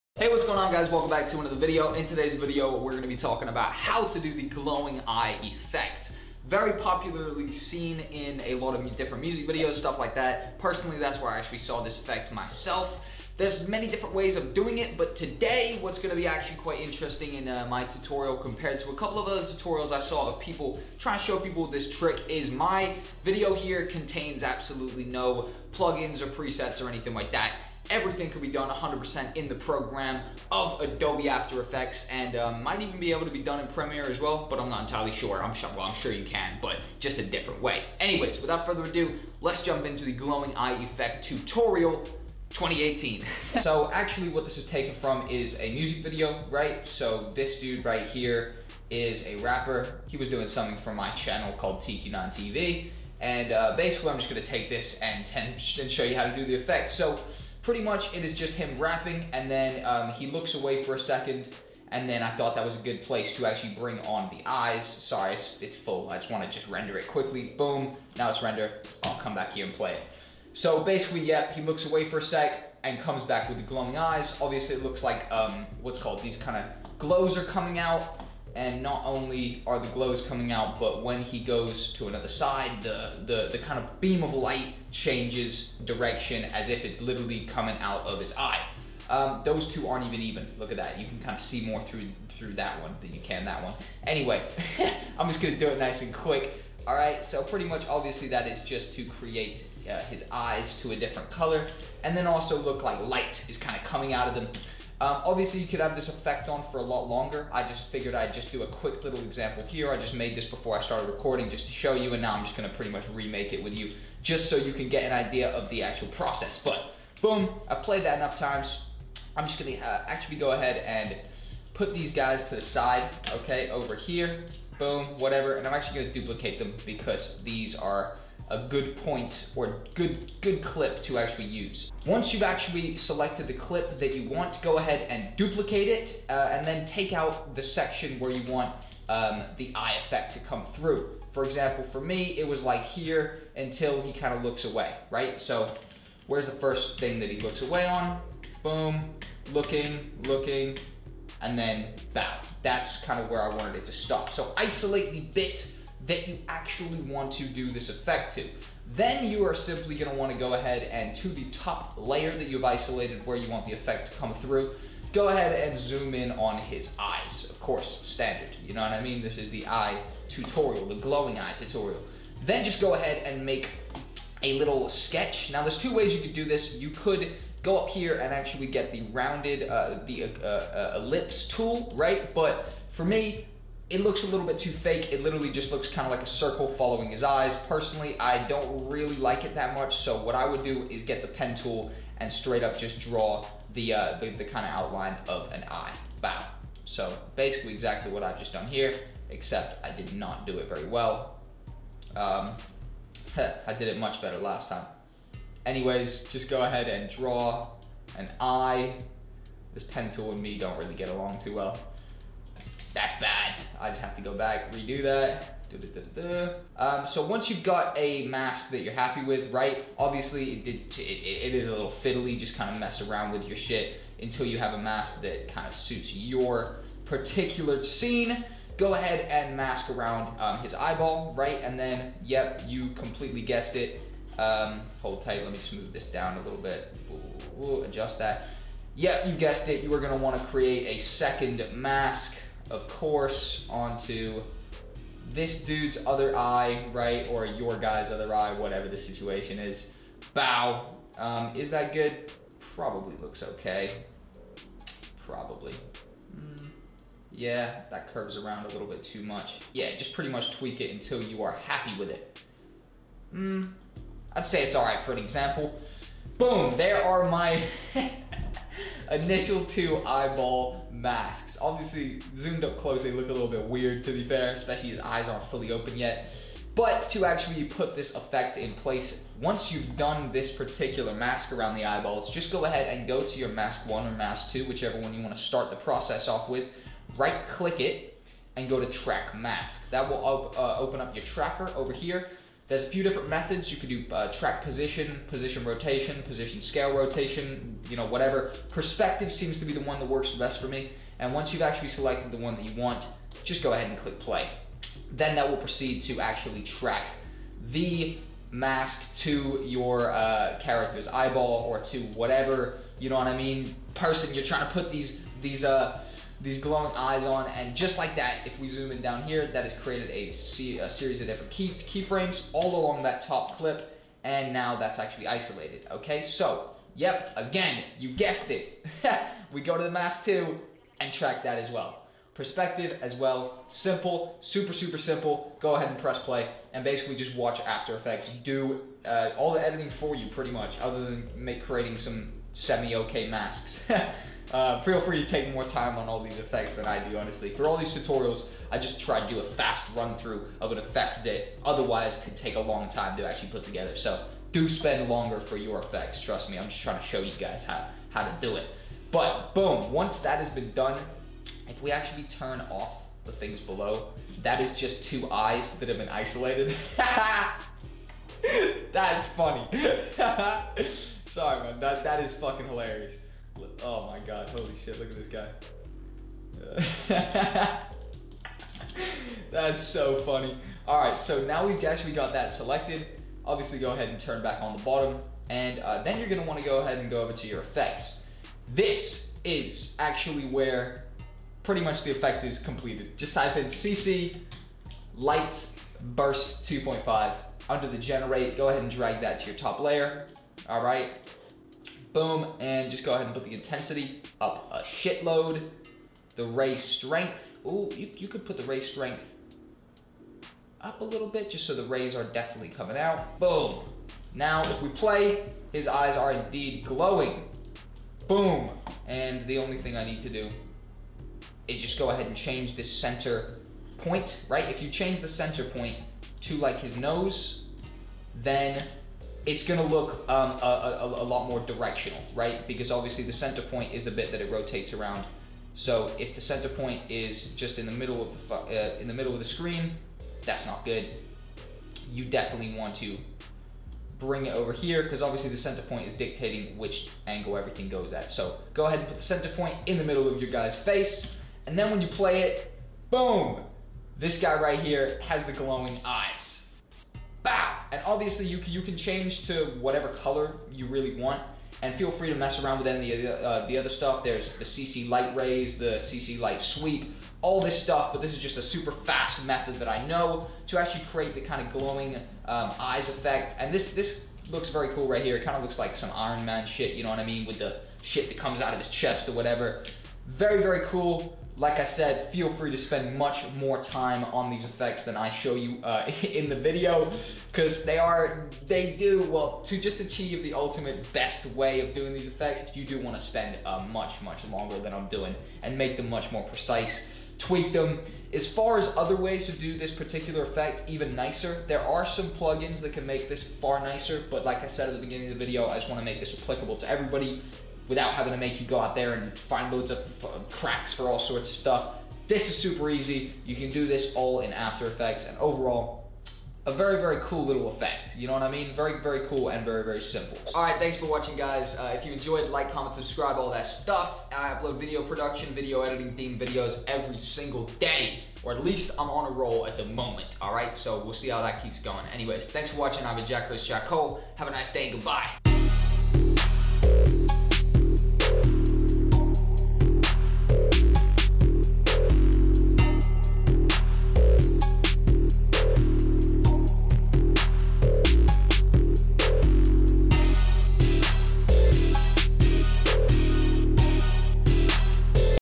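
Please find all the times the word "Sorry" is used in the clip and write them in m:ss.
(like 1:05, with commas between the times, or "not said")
1:04, 6:11.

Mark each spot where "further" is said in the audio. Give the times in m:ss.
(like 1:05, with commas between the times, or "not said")
0:38.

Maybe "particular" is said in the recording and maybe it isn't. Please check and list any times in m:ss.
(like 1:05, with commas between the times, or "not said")
3:47, 4:40, 8:19.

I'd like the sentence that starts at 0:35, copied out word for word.
I'm sure, well, I'm sure you can, but just a different way.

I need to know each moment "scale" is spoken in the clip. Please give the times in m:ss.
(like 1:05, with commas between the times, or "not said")
4:56.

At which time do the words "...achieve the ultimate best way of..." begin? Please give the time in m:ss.
8:09.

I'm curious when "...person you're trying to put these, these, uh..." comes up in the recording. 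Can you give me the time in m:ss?
5:13.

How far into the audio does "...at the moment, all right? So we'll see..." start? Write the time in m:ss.
8:49.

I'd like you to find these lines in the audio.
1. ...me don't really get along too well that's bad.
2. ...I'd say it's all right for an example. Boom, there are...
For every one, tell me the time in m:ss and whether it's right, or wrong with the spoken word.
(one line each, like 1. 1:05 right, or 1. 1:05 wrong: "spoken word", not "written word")
1. 3:30 right
2. 4:24 right.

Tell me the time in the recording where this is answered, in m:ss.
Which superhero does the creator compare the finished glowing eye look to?
7:56.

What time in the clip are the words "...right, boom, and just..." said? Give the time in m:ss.
6:40.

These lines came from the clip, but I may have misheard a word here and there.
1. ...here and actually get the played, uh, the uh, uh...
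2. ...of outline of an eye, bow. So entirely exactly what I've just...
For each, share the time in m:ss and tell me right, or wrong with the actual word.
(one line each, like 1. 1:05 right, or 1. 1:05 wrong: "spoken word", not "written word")
1. 2:57 wrong: "rounded", not "played"
2. 3:14 wrong: "basically", not "entirely".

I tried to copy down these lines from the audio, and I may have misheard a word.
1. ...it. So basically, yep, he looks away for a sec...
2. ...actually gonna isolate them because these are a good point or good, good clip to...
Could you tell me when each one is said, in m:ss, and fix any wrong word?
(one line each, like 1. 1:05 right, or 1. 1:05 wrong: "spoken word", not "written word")
1. 1:09 right
2. 2:05 wrong: "duplicate", not "isolate".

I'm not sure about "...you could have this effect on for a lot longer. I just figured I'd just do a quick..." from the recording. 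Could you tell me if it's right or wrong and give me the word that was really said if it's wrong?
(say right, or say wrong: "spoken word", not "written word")
right.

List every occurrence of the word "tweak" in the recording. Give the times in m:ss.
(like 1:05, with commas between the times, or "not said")
4:20, 8:17.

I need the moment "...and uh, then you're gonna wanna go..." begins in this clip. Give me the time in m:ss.
6:25.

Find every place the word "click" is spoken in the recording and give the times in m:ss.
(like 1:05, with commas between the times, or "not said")
4:47, 5:03.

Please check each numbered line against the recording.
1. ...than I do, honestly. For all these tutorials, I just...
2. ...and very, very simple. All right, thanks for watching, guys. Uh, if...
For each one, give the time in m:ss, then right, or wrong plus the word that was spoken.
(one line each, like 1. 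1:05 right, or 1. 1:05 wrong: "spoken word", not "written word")
1. 5:46 right
2. 8:39 right.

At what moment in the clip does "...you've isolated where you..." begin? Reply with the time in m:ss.
2:42.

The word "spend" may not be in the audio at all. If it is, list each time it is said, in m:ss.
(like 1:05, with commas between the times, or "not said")
5:54, 8:02, 8:13.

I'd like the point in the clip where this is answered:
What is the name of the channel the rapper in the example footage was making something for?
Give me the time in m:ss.
0:51.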